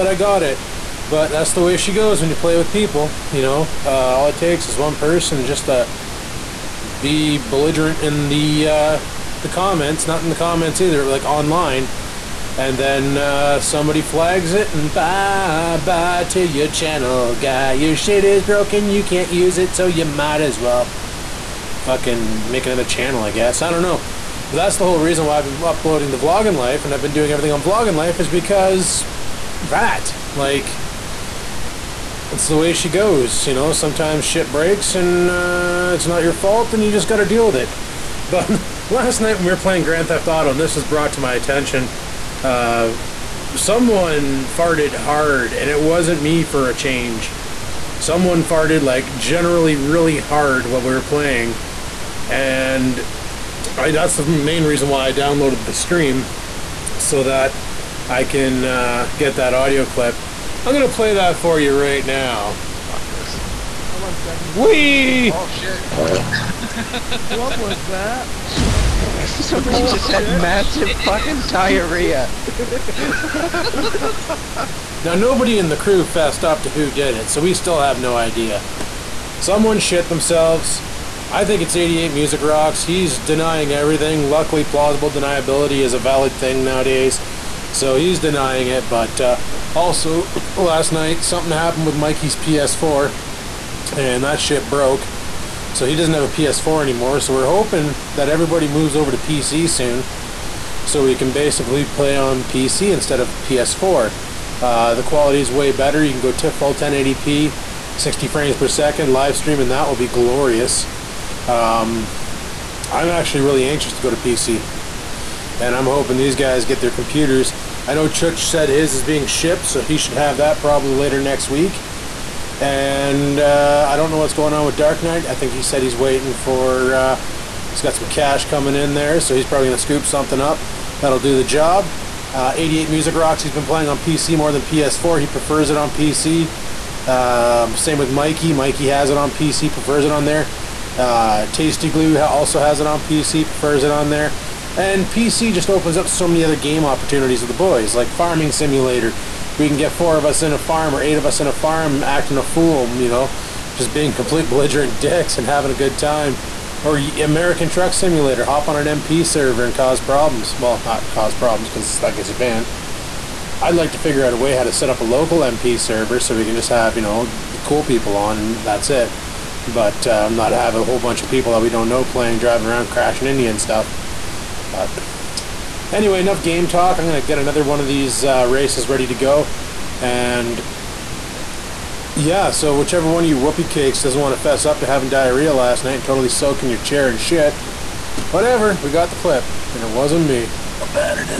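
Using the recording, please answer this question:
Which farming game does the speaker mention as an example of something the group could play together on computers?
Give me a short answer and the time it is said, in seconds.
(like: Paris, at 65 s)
Farming Simulator, at 148 s.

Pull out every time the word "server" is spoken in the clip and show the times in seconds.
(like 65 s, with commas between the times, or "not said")
159 s, 165 s.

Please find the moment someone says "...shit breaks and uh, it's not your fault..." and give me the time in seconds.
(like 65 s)
34 s.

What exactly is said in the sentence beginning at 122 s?
And uh, I don't know what's going on with Dark Knight.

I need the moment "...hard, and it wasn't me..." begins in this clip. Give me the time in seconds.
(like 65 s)
44 s.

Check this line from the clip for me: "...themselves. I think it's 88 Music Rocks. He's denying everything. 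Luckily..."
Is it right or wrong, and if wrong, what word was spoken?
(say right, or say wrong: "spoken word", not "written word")
right.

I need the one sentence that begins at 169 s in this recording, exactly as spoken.
But uh, not have a whole bunch of people that we don't know playing, driving around, crashing Indian stuff.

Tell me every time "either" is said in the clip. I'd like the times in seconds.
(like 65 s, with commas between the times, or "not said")
10 s.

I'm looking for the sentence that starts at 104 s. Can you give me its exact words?
Uh, the quality is way better.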